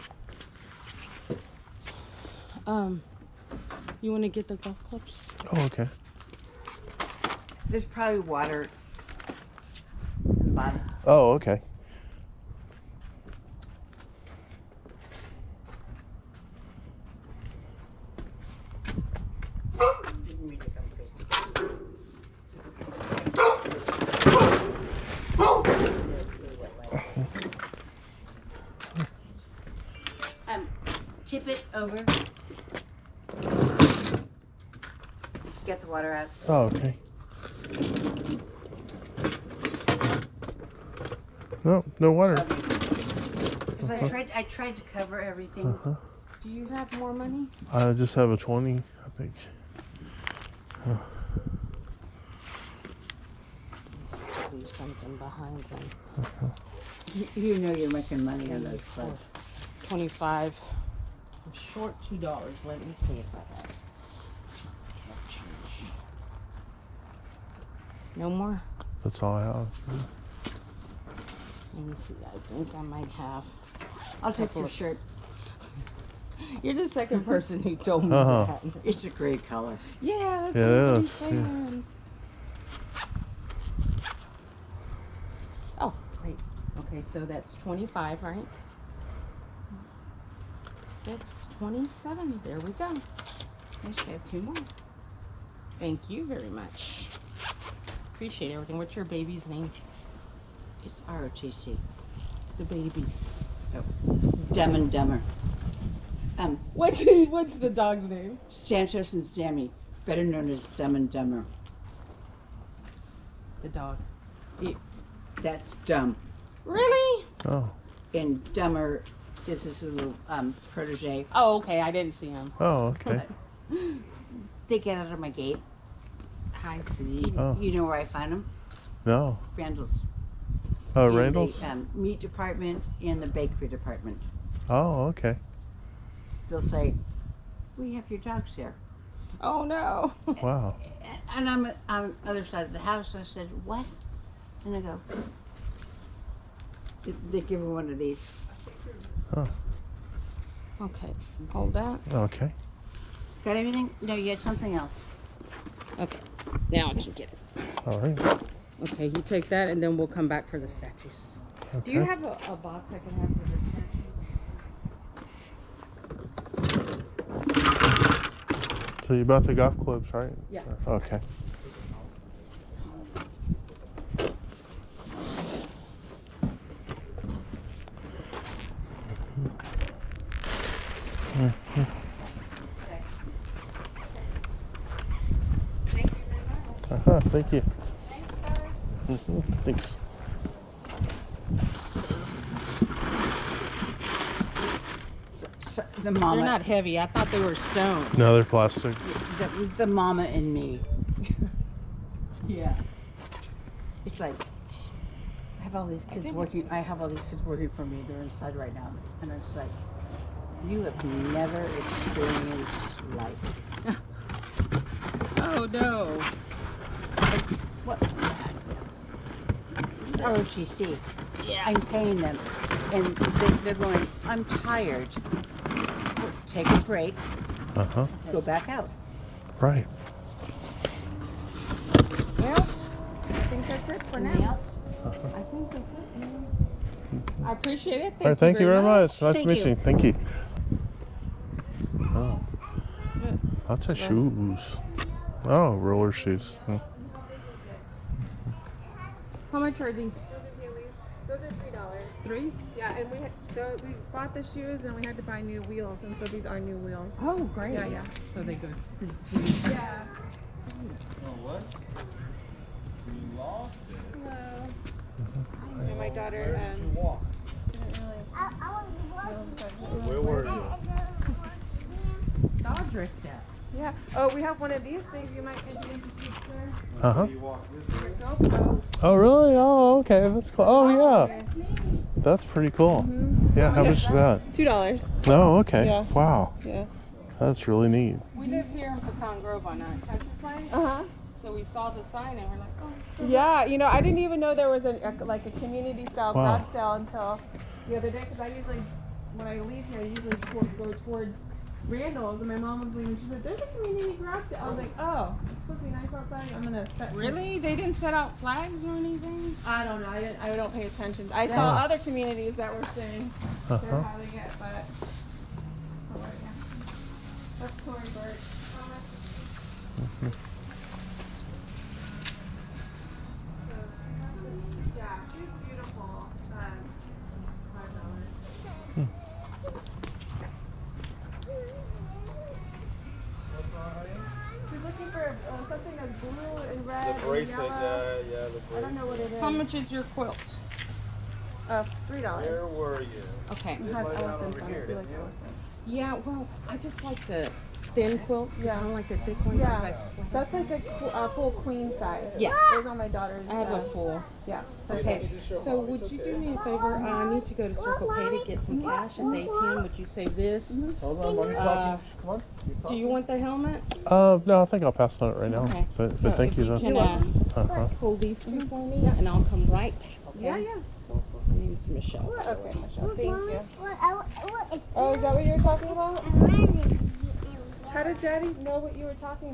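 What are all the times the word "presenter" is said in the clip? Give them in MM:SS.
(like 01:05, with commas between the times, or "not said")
not said.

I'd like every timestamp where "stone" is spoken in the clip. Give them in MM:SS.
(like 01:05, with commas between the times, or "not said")
03:17.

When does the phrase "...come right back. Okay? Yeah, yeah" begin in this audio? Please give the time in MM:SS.
06:09.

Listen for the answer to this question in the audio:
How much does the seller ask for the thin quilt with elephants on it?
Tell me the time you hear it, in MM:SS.
05:42.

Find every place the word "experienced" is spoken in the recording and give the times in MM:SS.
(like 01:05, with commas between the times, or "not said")
03:31.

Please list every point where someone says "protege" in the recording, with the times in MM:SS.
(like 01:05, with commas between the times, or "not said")
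02:00.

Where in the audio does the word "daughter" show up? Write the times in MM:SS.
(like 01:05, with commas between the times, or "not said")
04:26, 05:53.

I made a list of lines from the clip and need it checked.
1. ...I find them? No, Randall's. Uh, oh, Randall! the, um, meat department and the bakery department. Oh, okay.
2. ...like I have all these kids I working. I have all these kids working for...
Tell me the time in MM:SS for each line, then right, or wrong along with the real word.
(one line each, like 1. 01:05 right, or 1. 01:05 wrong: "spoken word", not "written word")
1. 02:07 right
2. 03:24 right.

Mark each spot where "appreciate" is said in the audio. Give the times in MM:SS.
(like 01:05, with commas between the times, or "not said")
01:38, 03:57.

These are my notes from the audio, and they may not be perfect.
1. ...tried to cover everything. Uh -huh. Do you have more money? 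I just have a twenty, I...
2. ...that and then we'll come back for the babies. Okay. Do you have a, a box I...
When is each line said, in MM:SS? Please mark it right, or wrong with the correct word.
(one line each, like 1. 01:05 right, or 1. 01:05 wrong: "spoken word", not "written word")
1. 00:44 right
2. 02:39 wrong: "statues", not "babies".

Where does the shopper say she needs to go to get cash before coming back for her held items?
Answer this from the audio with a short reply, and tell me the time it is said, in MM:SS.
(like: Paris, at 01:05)
Circle K, at 05:57.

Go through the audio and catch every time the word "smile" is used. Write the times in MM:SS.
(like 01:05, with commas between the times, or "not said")
not said.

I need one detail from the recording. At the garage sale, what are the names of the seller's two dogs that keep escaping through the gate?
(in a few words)
Santos and Sammy.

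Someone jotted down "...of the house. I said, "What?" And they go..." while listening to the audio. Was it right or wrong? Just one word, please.
right.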